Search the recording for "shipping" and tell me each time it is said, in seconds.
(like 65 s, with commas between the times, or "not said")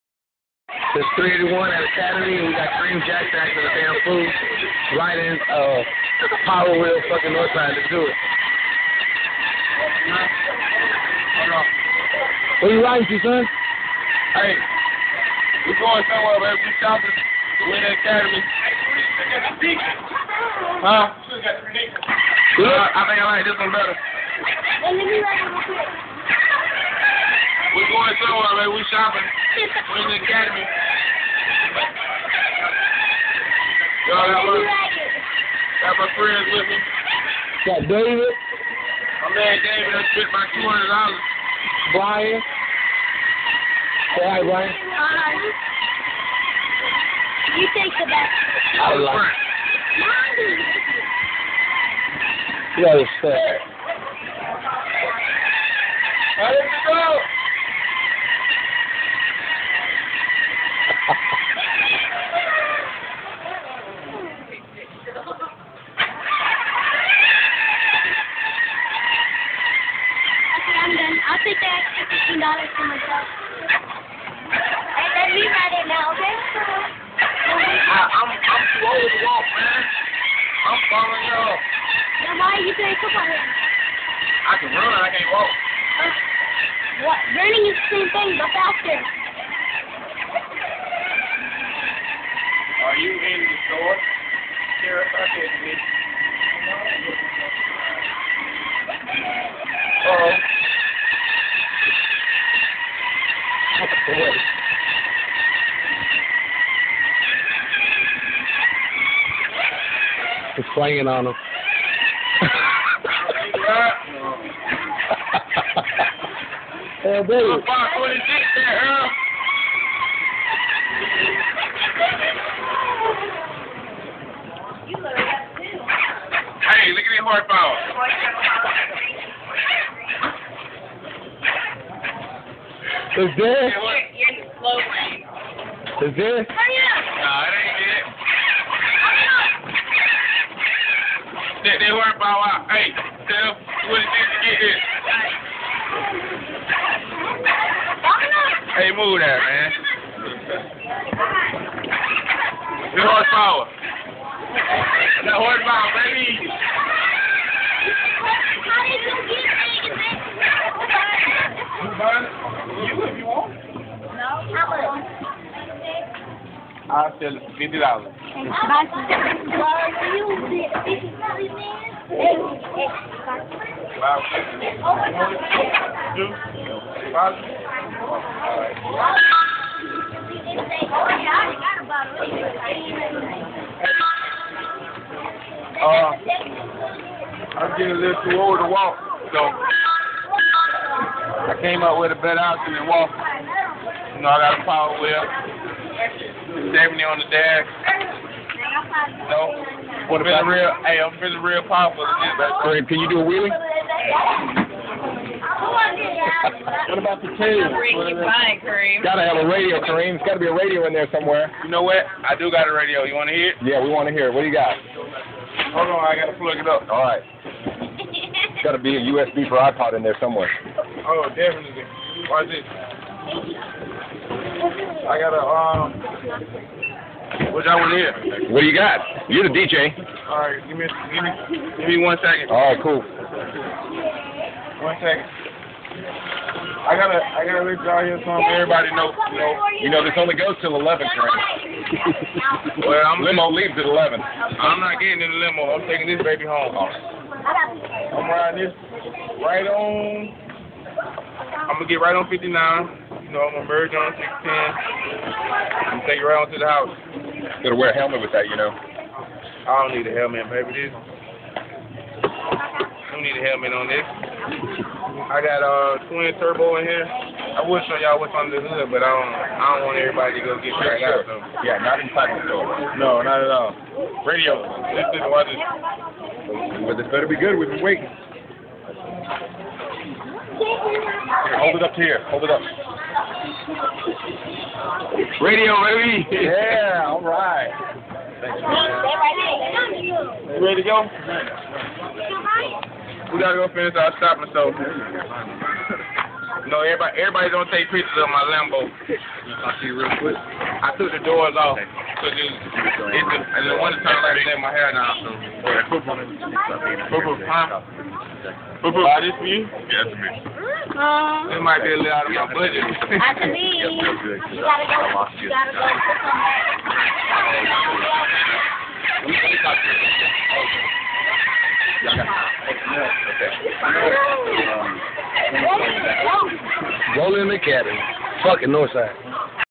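not said.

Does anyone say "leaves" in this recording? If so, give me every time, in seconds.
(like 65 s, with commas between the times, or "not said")
243 s, 313 s.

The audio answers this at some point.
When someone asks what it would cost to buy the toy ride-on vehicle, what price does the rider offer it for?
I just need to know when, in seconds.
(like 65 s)
167 s.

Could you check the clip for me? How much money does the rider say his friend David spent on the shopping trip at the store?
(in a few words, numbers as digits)
$200.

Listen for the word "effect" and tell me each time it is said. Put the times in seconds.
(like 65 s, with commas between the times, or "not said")
not said.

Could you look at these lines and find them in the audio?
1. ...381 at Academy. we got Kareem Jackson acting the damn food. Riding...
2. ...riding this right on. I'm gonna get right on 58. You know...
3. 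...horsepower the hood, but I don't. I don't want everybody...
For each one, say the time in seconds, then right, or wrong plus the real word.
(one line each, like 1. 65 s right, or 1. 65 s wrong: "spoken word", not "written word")
1. 1 s right
2. 248 s wrong: "59", not "58"
3. 268 s wrong: "under", not "horsepower".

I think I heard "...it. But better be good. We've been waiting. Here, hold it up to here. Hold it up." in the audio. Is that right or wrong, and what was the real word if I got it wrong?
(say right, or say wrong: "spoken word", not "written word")
right.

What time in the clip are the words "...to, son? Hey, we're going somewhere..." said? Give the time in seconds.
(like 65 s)
13 s.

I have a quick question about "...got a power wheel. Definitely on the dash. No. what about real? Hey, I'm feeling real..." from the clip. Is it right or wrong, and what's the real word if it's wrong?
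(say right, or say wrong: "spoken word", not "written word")
right.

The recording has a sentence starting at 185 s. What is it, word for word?
Uh, I'm getting a little too old to walk, so.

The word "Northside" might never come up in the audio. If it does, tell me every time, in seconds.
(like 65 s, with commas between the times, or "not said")
7 s, 328 s.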